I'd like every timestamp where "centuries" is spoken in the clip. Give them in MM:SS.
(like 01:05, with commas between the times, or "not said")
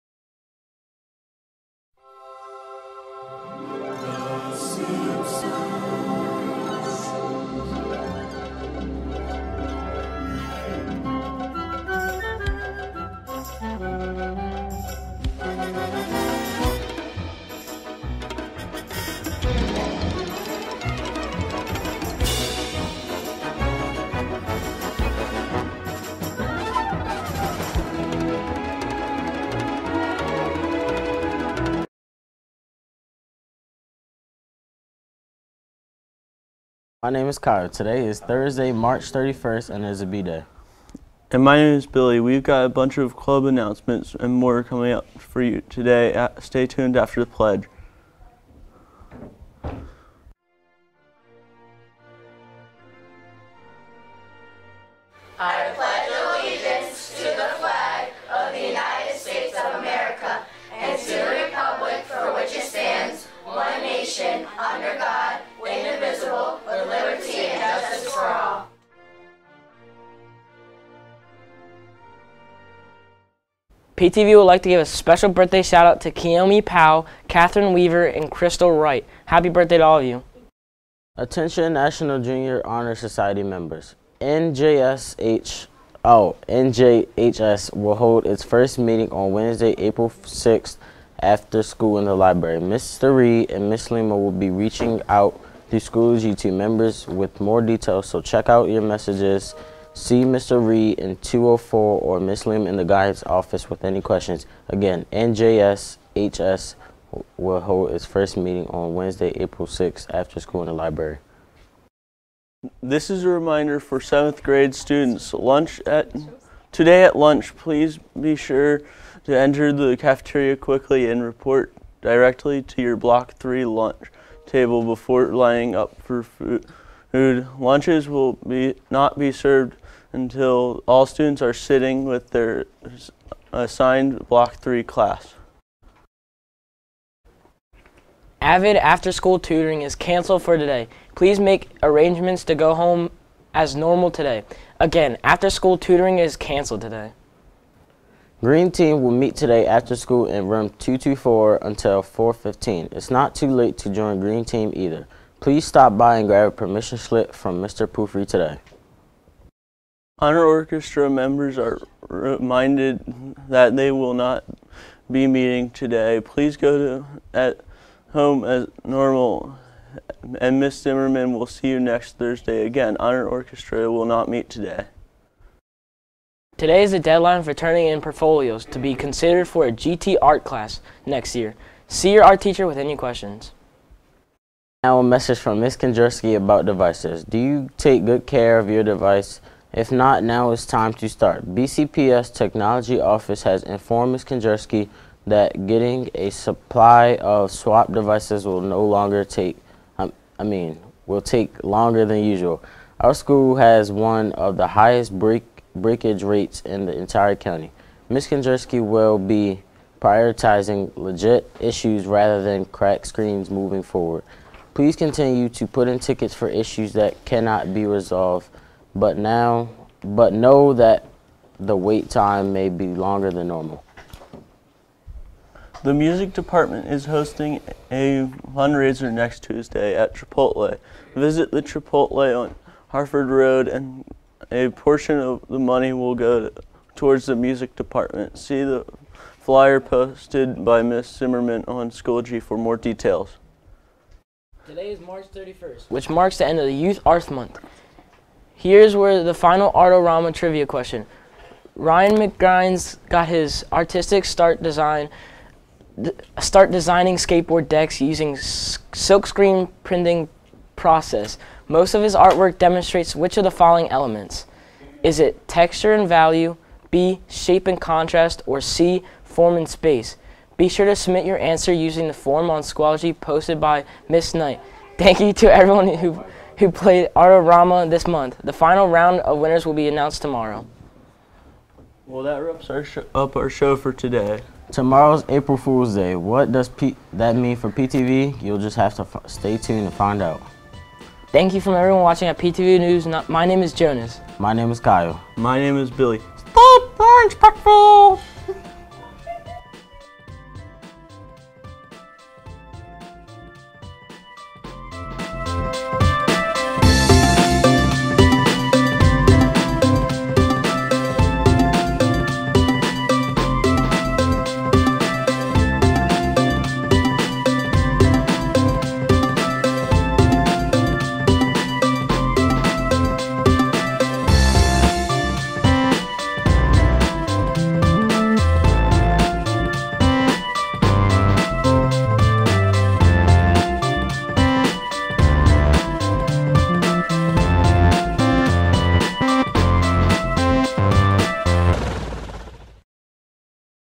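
not said.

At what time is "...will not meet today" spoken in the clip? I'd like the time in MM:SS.
02:53.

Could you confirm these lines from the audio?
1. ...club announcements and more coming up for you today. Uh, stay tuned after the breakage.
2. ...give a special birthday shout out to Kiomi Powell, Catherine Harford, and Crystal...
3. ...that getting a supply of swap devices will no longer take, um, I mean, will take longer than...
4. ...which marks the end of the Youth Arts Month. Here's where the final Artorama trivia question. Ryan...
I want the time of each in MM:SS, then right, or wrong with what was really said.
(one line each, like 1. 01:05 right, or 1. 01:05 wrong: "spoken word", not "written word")
1. 00:43 wrong: "pledge", not "breakage"
2. 01:14 wrong: "Weaver", not "Harford"
3. 03:15 right
4. 04:05 right.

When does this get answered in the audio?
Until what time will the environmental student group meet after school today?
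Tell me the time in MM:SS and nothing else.
02:32.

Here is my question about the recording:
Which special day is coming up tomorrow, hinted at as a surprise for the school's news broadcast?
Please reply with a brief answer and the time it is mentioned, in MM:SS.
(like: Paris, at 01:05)
April Fool's Day, at 04:45.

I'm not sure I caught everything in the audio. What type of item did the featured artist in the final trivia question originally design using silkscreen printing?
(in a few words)
skateboard decks.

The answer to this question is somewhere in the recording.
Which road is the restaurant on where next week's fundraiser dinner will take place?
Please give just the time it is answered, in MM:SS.
03:52.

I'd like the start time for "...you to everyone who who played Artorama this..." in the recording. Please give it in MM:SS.
04:35.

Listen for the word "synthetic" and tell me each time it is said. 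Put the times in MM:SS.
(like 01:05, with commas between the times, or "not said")
not said.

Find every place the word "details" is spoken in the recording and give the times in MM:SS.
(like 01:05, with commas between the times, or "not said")
01:37, 04:02.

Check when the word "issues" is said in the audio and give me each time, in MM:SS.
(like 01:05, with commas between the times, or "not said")
03:31, 03:36.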